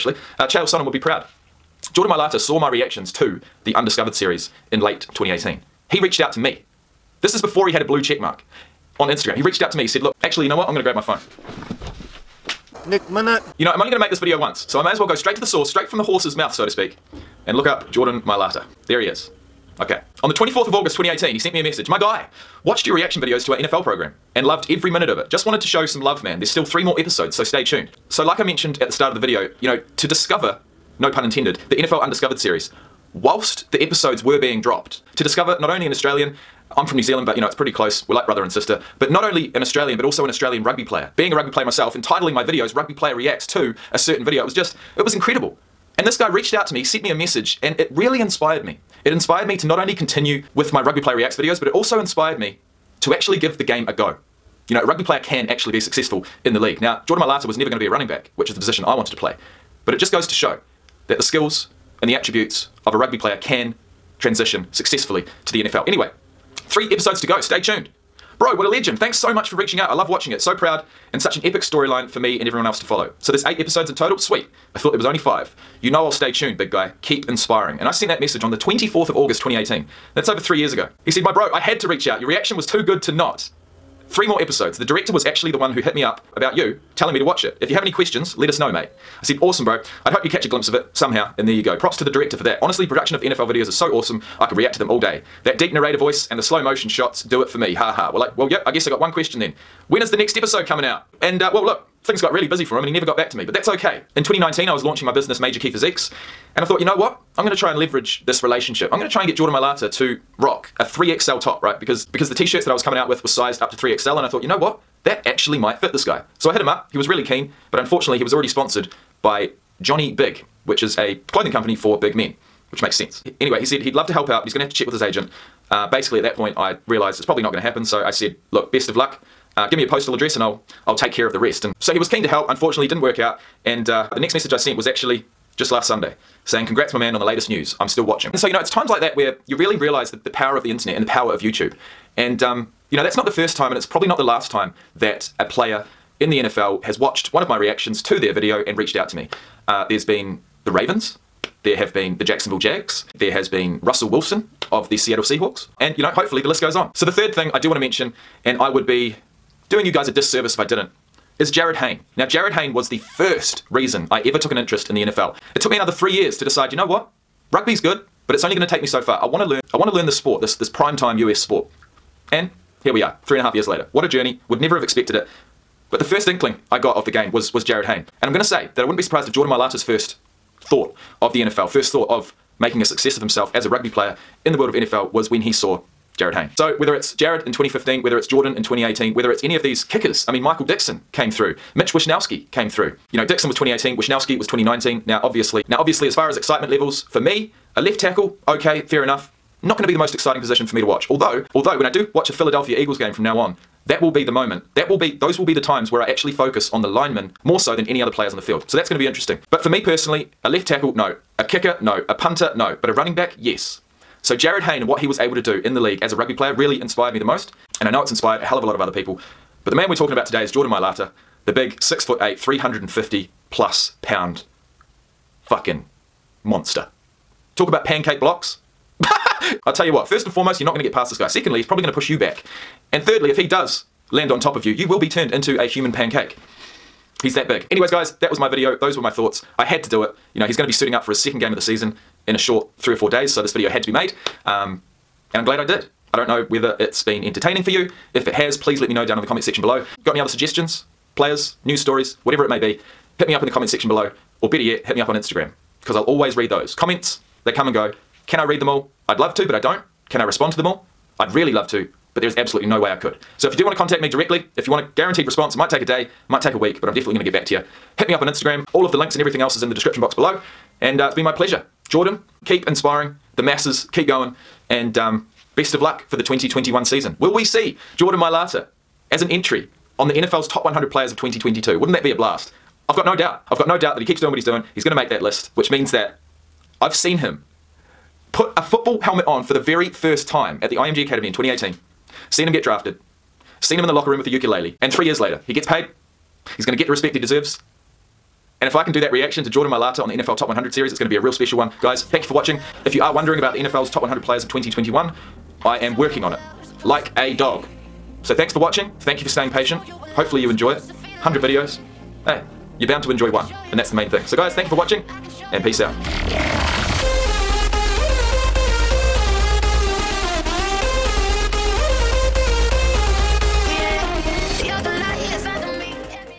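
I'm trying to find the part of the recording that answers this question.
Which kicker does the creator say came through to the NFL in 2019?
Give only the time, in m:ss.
3:13.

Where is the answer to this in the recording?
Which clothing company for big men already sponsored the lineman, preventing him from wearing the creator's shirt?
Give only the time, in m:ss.
1:59.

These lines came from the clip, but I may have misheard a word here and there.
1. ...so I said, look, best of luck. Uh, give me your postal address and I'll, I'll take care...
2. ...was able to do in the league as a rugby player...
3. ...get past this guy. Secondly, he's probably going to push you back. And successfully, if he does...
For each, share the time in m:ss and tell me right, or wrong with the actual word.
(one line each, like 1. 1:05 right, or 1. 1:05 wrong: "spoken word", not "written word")
1. 2:07 right
2. 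3:35 right
3. 3:50 wrong: "thirdly", not "successfully".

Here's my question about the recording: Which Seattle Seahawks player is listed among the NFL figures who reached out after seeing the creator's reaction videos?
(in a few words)
Russell Wilson.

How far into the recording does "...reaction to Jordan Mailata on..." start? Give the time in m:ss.
4:59.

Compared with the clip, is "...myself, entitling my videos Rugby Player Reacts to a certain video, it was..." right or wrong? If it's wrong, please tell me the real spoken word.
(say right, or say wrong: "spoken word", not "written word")
right.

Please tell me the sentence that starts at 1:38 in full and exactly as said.
Well, I, well yep, I guess I got one question then.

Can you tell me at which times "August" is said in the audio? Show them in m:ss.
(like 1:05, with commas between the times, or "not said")
0:20, 1:19.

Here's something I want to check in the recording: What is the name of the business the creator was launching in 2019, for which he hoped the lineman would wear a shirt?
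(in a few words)
Major Key Physiques.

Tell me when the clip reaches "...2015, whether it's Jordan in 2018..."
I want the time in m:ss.
3:07.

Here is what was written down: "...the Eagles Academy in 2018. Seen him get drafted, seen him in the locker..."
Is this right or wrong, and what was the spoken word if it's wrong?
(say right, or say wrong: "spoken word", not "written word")
wrong: "IMG", not "Eagles".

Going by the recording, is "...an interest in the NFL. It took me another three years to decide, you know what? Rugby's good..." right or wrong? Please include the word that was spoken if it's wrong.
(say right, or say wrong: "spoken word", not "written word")
right.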